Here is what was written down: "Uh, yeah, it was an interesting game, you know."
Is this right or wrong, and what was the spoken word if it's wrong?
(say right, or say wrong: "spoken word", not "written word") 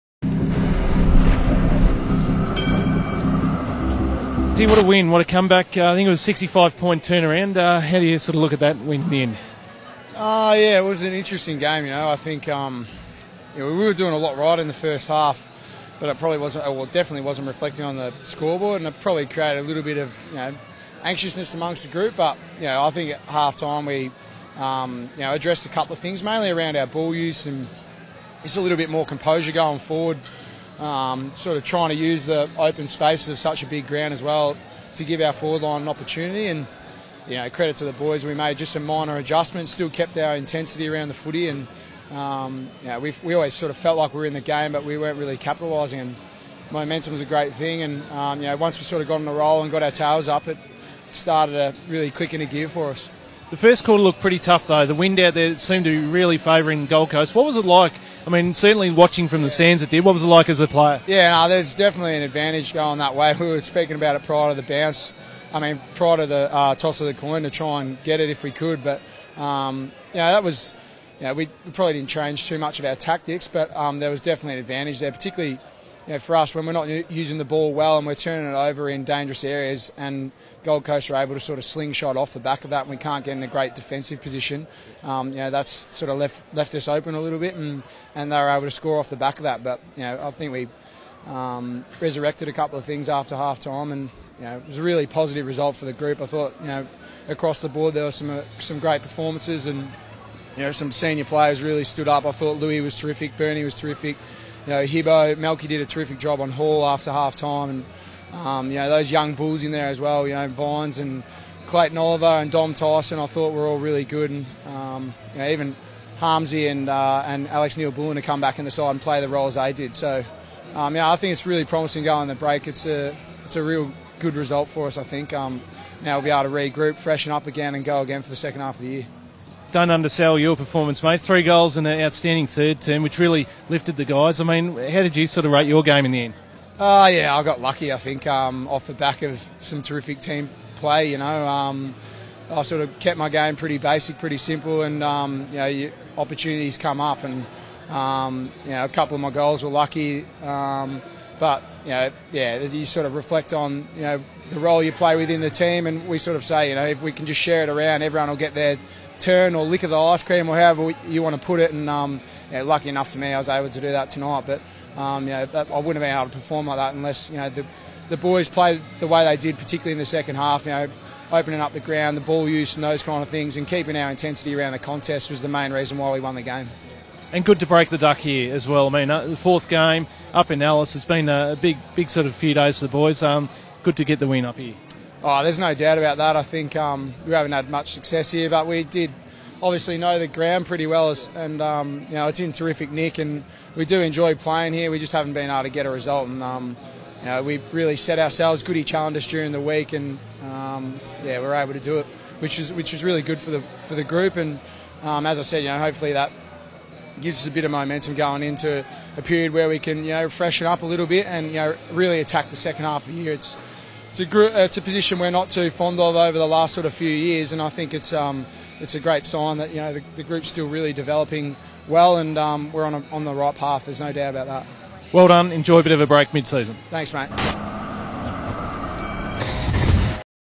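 right.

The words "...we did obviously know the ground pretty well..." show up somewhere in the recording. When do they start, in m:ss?
3:08.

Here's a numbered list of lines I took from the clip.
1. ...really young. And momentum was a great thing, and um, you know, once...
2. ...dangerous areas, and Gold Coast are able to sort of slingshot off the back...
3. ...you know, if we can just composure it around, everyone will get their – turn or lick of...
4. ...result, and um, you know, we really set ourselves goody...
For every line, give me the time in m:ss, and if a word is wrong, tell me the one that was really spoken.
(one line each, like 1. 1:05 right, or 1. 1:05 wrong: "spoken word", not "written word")
1. 0:45 wrong: "capitalising", not "young"
2. 1:19 right
3. 2:36 wrong: "share", not "composure"
4. 3:15 right.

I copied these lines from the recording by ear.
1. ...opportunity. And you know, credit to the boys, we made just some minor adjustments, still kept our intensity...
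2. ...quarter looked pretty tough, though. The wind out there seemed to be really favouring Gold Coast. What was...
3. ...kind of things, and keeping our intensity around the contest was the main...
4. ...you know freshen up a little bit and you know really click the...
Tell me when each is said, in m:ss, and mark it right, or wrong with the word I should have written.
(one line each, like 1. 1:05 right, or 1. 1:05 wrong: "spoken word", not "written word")
1. 0:35 right
2. 0:53 right
3. 2:53 right
4. 3:30 wrong: "attack", not "click".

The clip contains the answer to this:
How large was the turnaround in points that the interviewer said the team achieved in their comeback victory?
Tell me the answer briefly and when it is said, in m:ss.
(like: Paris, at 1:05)
65, at 0:06.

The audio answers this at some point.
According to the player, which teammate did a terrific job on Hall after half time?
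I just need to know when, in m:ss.
1:45.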